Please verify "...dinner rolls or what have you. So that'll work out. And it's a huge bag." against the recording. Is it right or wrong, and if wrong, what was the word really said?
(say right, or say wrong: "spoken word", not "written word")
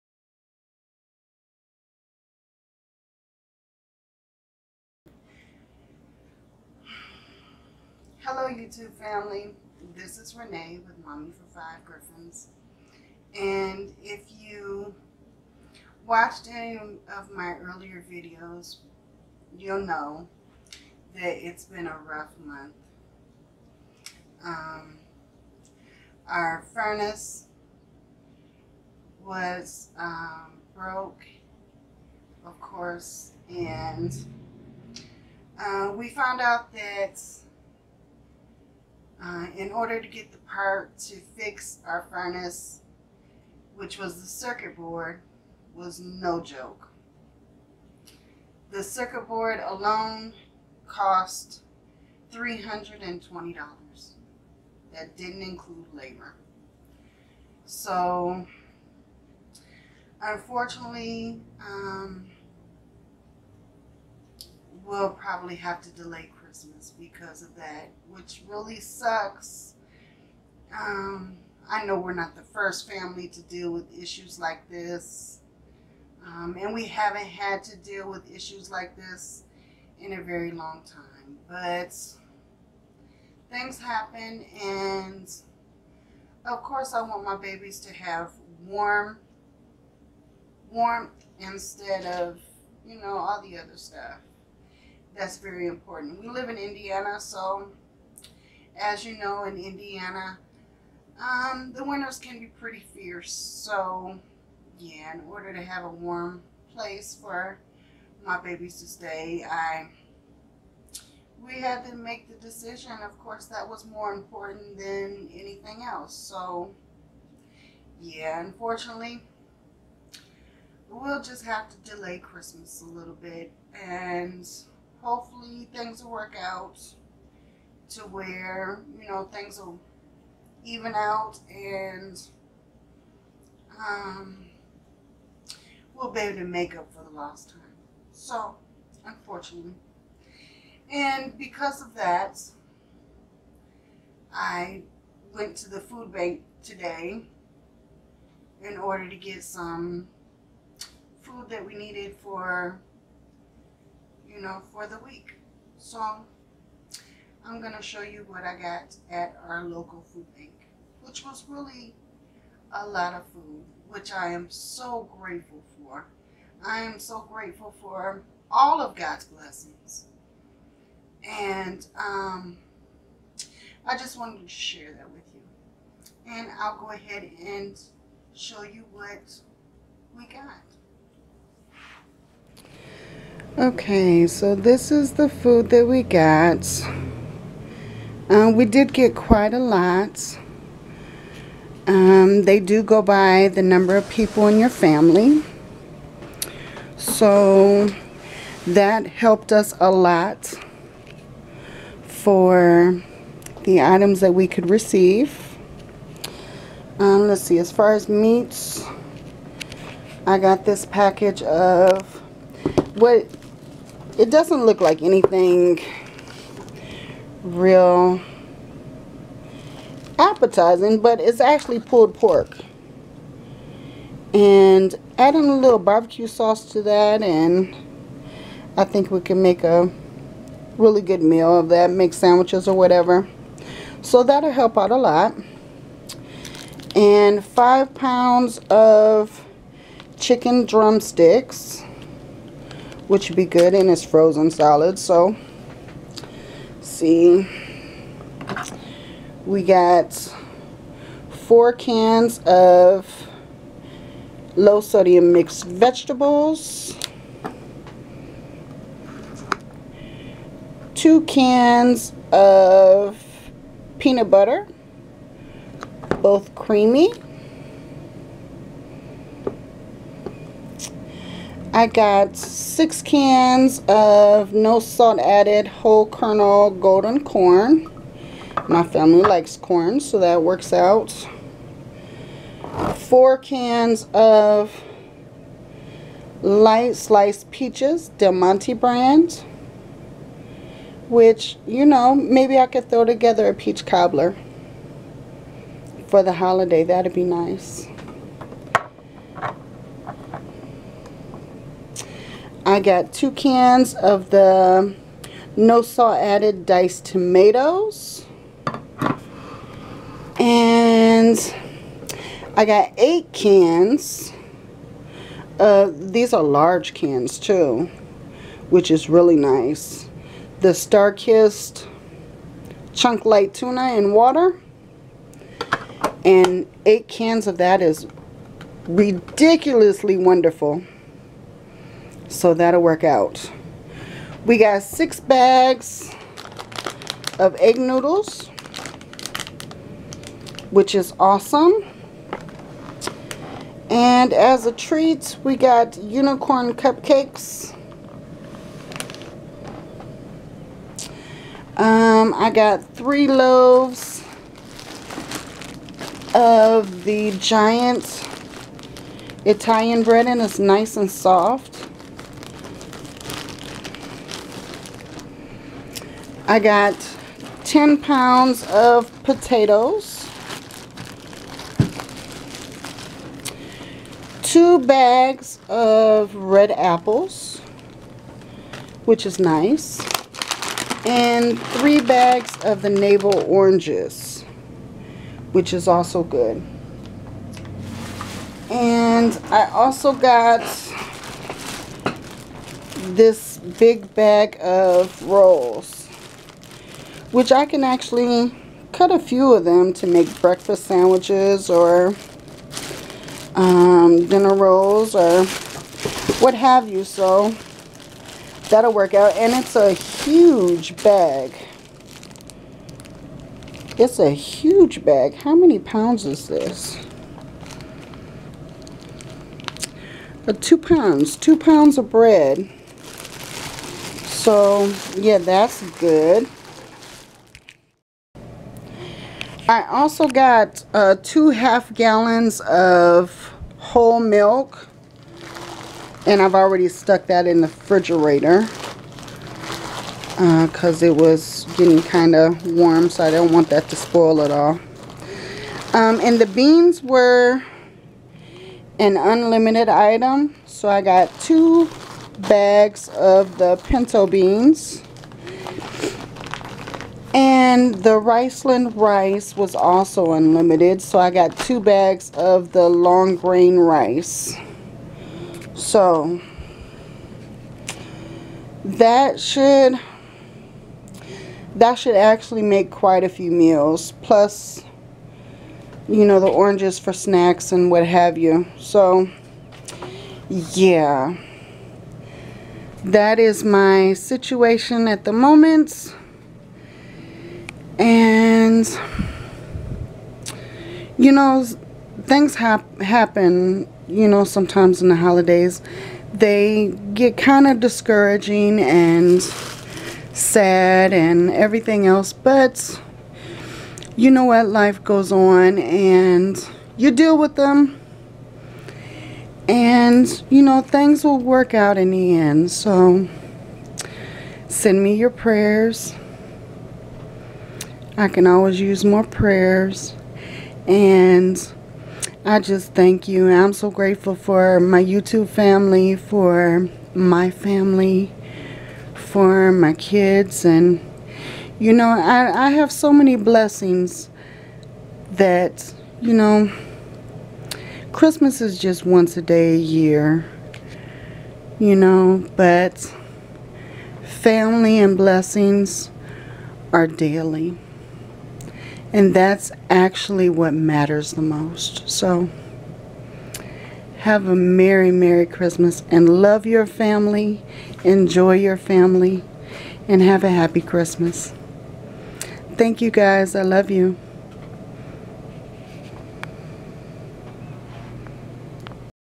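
right.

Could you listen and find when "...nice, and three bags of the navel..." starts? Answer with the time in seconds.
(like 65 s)
379 s.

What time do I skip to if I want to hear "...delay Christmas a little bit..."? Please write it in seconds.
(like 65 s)
121 s.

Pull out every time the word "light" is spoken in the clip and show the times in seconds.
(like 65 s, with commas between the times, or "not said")
286 s, 323 s.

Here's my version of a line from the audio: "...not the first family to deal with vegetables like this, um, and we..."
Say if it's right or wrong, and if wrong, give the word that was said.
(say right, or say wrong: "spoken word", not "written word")
wrong: "issues", not "vegetables".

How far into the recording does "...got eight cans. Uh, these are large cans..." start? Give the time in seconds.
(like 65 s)
312 s.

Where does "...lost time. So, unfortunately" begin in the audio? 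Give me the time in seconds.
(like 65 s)
137 s.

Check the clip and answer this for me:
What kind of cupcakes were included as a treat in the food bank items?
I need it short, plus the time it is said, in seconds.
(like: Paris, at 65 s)
unicorn cupcakes, at 346 s.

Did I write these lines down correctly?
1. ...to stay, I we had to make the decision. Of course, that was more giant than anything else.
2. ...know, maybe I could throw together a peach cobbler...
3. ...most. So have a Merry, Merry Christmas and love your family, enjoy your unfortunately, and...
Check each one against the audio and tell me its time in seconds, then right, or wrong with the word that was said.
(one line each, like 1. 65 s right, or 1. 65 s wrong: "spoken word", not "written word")
1. 108 s wrong: "important", not "giant"
2. 291 s right
3. 551 s wrong: "family", not "unfortunately".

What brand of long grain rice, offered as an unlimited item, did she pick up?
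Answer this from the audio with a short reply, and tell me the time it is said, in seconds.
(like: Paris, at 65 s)
Riceland, at 458 s.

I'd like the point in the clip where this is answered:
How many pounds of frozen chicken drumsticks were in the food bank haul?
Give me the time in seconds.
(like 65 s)
237 s.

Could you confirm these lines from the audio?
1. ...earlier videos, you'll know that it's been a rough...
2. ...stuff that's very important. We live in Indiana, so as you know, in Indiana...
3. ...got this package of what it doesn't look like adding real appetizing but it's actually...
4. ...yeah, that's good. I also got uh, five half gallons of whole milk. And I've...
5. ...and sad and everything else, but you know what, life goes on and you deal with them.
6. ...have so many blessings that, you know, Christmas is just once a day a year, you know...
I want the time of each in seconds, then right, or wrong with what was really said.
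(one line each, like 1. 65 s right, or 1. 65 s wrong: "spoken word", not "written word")
1. 17 s right
2. 93 s right
3. 210 s wrong: "anything", not "adding"
4. 425 s wrong: "two", not "five"
5. 498 s right
6. 532 s right.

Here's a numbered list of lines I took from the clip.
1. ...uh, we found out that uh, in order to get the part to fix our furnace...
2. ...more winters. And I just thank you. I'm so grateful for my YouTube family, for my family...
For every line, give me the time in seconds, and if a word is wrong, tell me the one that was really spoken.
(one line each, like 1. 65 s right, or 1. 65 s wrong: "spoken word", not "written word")
1. 35 s right
2. 519 s wrong: "prayers", not "winters".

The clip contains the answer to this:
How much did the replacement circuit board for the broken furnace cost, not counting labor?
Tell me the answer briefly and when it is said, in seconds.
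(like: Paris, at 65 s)
$320, at 52 s.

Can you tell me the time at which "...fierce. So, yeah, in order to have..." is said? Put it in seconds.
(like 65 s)
102 s.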